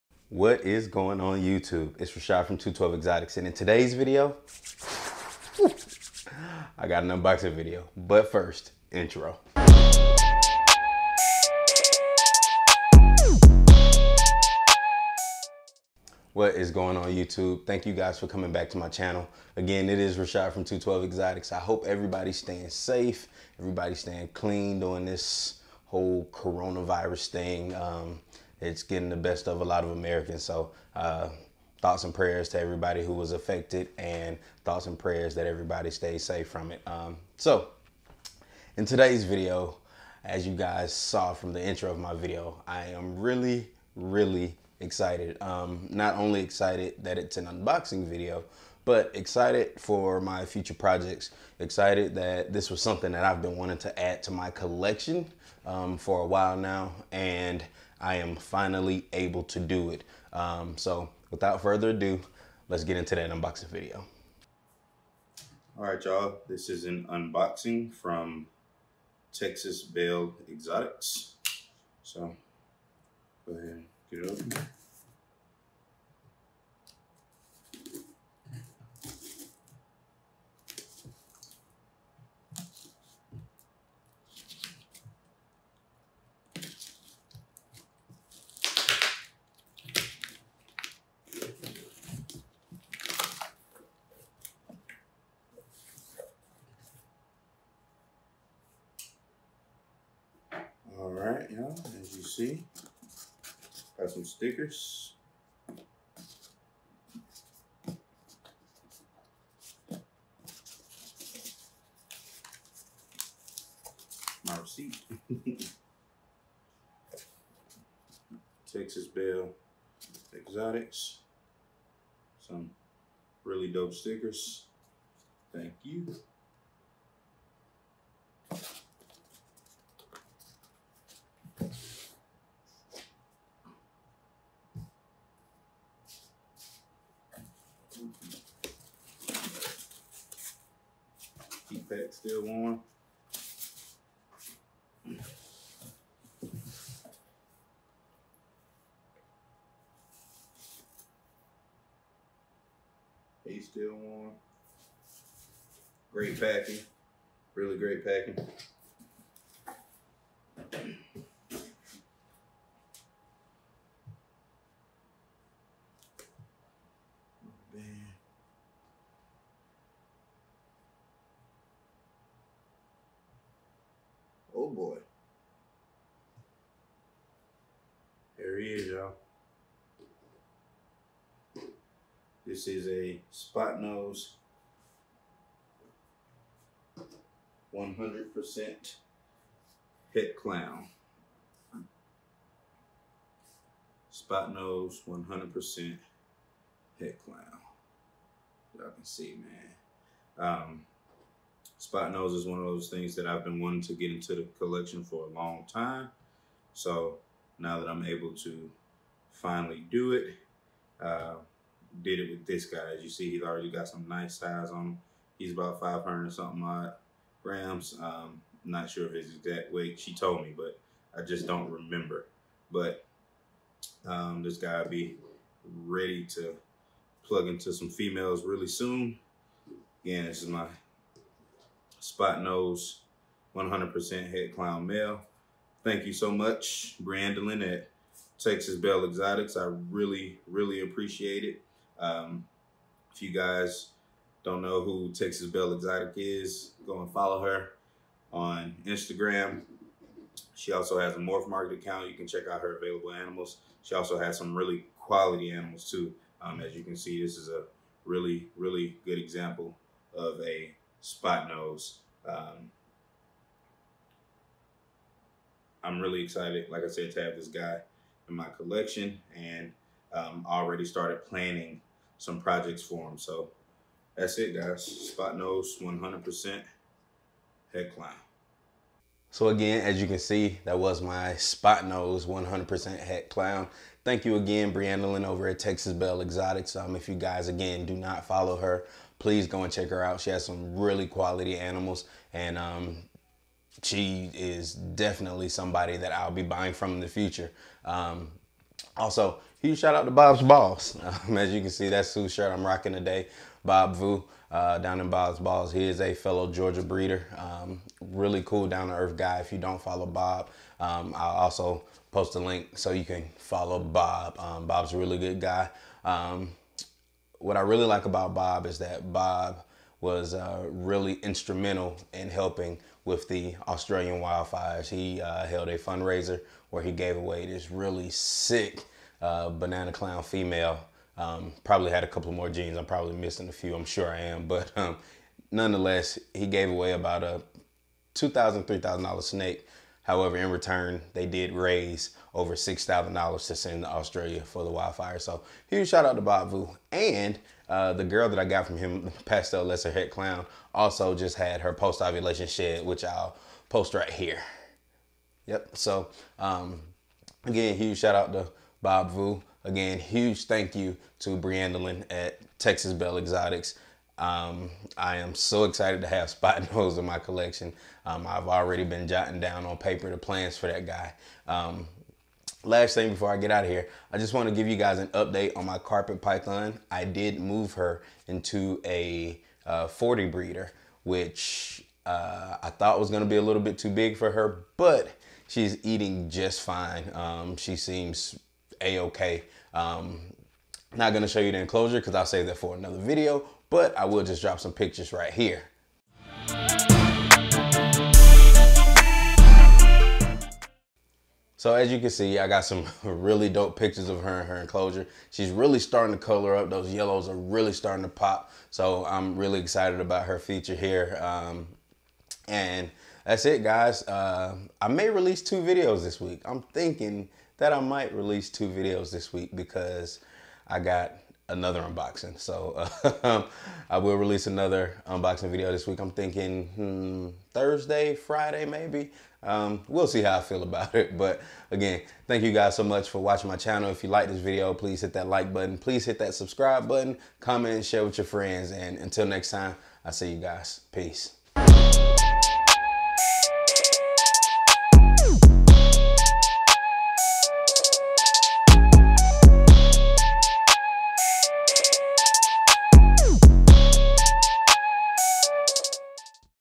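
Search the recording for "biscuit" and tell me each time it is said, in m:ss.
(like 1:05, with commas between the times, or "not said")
not said.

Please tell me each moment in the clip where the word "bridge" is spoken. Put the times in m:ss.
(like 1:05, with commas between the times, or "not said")
not said.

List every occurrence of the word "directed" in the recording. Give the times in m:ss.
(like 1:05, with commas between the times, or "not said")
not said.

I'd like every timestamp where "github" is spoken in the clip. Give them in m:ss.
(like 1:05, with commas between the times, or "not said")
not said.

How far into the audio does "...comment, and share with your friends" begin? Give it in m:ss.
7:17.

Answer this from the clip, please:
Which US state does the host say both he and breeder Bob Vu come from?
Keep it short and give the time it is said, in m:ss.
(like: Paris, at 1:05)
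Georgia, at 5:06.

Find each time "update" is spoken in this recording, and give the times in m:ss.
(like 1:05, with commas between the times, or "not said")
6:15.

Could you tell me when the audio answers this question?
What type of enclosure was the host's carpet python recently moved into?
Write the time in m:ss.
6:19.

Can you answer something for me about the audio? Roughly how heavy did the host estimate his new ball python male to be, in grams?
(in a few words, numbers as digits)
500.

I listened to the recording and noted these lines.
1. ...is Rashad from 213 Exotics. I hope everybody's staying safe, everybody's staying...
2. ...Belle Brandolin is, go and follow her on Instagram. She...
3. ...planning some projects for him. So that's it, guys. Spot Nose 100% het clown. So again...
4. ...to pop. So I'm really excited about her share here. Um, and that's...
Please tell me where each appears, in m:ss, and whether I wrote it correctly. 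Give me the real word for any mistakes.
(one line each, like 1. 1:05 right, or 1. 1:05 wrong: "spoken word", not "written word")
1. 0:19 wrong: "212", not "213"
2. 4:05 wrong: "Exotic", not "Brandolin"
3. 4:31 right
4. 6:48 wrong: "feature", not "share".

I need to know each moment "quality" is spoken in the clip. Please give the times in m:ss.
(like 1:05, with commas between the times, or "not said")
4:14, 4:51.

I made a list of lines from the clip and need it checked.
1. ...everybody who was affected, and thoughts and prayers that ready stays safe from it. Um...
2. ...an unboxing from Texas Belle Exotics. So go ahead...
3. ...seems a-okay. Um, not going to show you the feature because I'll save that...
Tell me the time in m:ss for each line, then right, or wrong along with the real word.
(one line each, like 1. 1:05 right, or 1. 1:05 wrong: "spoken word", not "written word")
1. 0:32 wrong: "everybody", not "ready"
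2. 1:06 right
3. 6:27 wrong: "enclosure", not "feature".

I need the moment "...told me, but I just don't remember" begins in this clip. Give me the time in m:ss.
3:40.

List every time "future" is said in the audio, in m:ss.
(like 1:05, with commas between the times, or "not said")
0:50, 4:57.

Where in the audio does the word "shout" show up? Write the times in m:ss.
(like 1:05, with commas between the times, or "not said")
4:59, 5:45, 5:57.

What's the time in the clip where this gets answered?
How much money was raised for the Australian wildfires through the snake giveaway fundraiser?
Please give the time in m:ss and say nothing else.
5:42.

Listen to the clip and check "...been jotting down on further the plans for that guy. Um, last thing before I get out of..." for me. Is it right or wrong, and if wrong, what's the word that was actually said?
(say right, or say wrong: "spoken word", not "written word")
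wrong: "paper", not "further".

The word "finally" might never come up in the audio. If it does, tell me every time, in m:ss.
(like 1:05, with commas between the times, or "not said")
0:58, 3:29.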